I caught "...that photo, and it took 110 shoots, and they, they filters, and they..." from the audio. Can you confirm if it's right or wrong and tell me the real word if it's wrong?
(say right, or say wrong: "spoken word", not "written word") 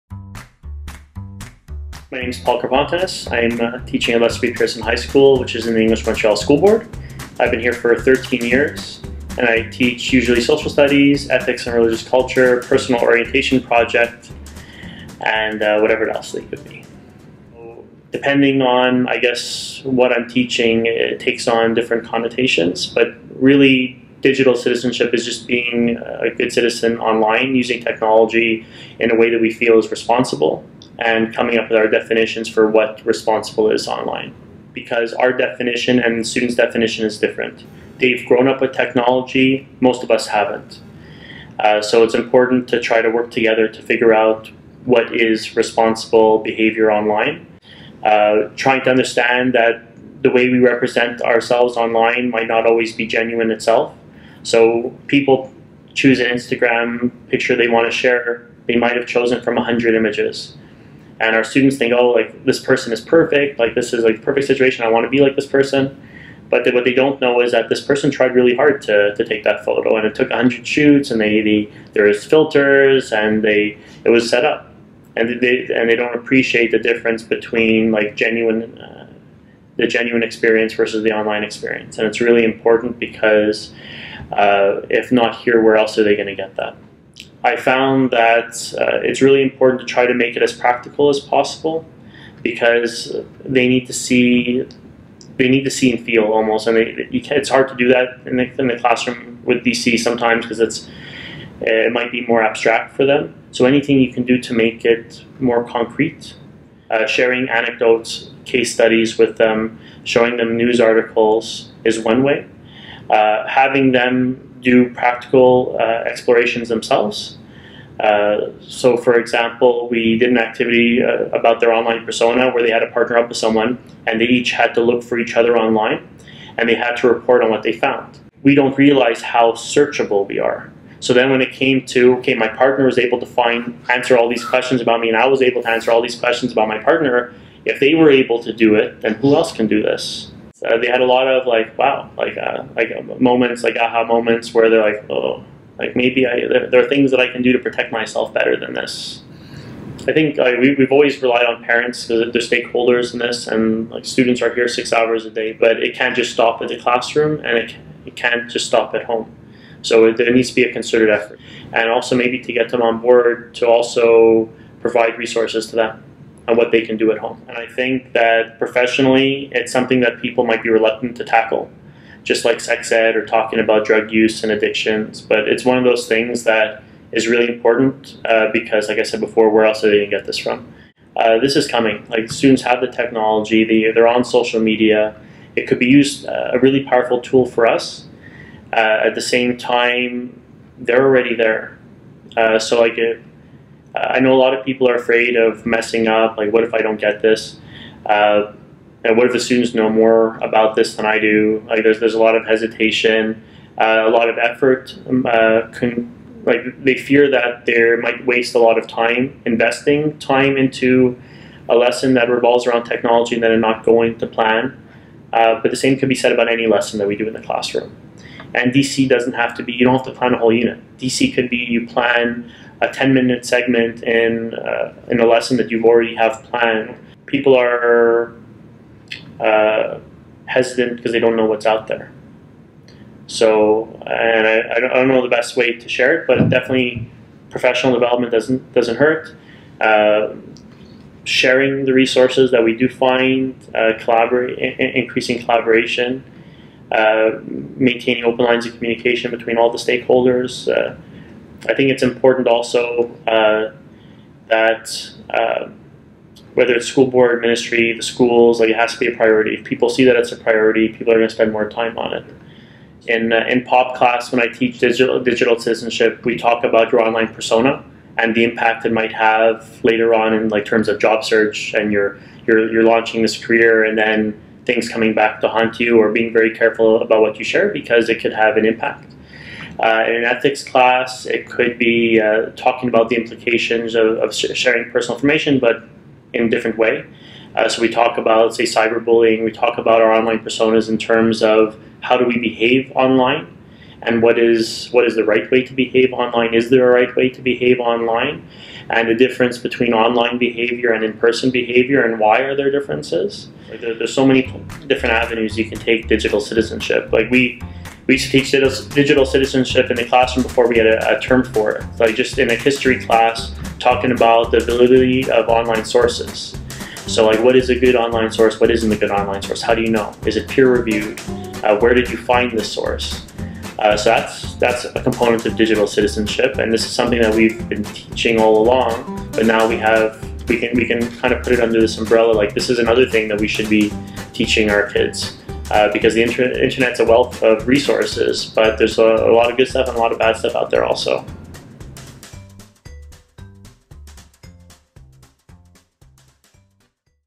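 wrong: "100", not "110".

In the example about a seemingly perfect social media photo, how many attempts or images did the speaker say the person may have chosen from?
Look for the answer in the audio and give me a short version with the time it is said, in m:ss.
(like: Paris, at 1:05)
100, at 0:59.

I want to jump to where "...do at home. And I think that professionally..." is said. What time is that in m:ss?
2:46.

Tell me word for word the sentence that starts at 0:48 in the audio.
Uh, trying to understand that the way we represent ourselves online might not always be genuine itself.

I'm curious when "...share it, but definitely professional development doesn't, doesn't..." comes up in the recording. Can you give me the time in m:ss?
3:55.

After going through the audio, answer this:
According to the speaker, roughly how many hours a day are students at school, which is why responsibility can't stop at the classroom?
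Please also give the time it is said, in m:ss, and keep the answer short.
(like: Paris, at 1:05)
6, at 2:34.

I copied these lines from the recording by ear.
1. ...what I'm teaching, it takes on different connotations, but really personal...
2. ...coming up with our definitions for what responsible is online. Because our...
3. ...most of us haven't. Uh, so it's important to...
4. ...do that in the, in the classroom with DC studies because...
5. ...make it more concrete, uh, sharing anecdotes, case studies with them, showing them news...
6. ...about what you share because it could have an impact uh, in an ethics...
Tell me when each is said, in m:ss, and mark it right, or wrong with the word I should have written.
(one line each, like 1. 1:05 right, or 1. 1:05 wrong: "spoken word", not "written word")
1. 0:19 wrong: "digital", not "personal"
2. 0:31 right
3. 0:39 right
4. 1:37 wrong: "sometimes", not "studies"
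5. 1:44 right
6. 4:37 right.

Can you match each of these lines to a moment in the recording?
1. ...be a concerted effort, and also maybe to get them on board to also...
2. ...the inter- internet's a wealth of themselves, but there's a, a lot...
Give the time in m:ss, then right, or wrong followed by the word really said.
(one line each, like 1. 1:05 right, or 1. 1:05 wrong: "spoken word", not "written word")
1. 2:40 right
2. 5:36 wrong: "resources", not "themselves".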